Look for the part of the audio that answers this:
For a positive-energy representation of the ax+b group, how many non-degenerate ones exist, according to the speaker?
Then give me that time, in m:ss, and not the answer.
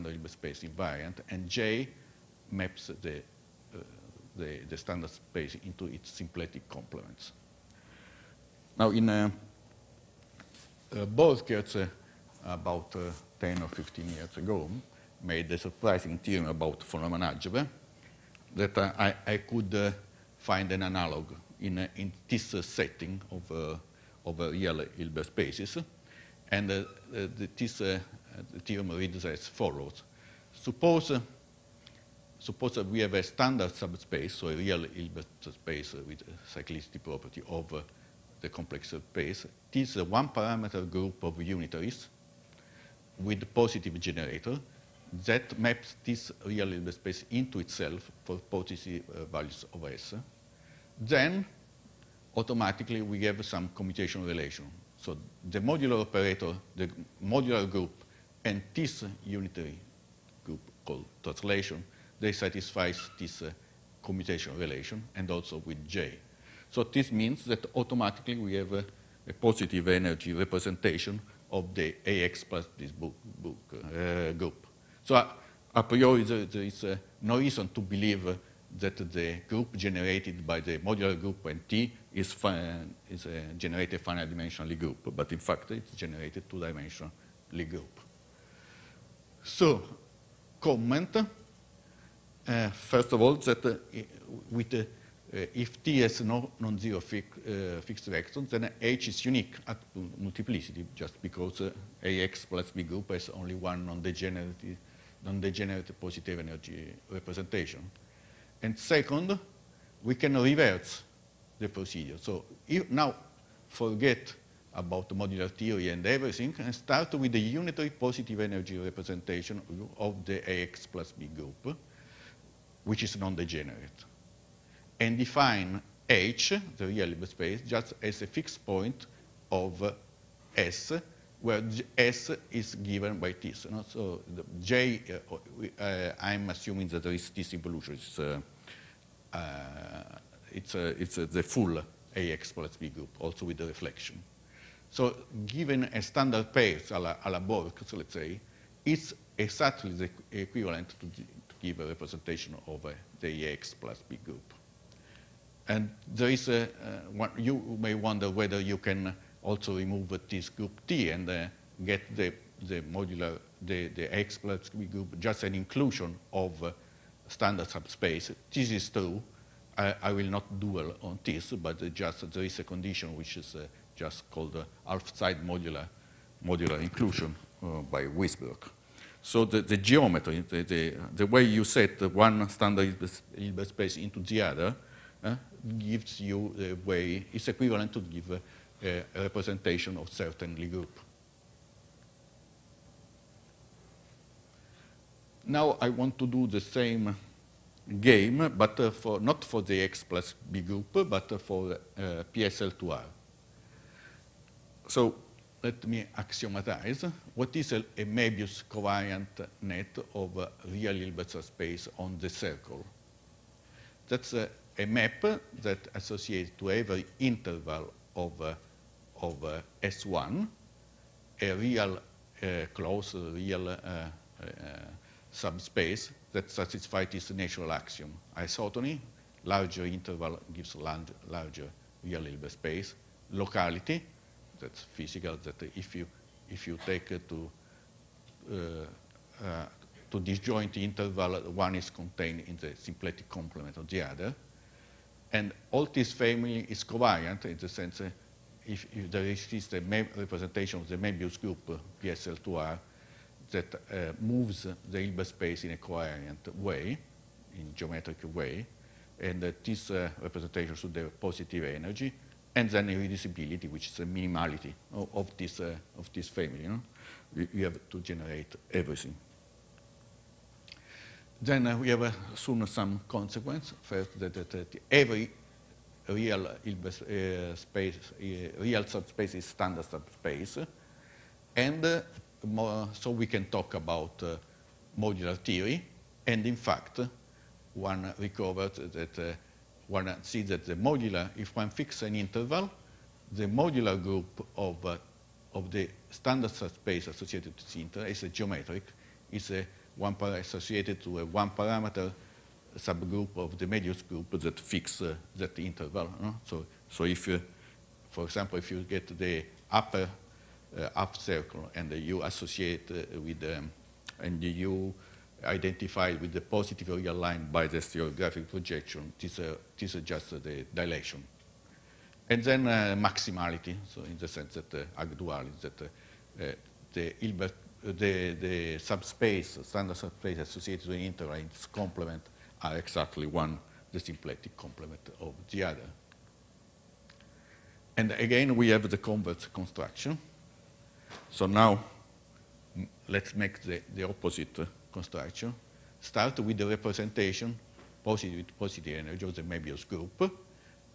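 1:43.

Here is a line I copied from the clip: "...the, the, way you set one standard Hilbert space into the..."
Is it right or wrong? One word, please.
right.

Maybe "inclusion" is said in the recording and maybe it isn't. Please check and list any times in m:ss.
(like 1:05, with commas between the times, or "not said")
2:45, 2:56.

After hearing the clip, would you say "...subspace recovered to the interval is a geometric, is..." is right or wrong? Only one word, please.
wrong.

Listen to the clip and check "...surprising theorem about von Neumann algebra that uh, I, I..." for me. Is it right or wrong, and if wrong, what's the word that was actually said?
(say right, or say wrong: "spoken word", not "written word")
right.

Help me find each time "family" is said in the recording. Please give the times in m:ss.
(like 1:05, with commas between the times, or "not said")
4:06, 4:26.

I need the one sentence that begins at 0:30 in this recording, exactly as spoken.
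Suppose, suppose we have a standard subspace, so a real Hilbert space with cyclicity property of the complex space.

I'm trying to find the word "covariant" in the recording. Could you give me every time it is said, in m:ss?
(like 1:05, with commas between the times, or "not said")
3:28, 4:06.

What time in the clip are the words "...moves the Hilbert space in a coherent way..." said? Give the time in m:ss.
4:14.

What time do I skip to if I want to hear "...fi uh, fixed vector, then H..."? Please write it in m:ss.
1:37.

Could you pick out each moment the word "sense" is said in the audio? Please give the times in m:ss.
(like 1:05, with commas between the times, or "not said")
4:07, 5:24.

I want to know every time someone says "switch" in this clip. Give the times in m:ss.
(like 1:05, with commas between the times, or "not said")
not said.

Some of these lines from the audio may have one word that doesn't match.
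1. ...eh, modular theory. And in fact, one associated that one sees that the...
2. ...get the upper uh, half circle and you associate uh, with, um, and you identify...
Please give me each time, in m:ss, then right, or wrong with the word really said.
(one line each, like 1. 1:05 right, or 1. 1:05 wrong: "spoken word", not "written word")
1. 4:44 wrong: "recovered", not "associated"
2. 5:08 right.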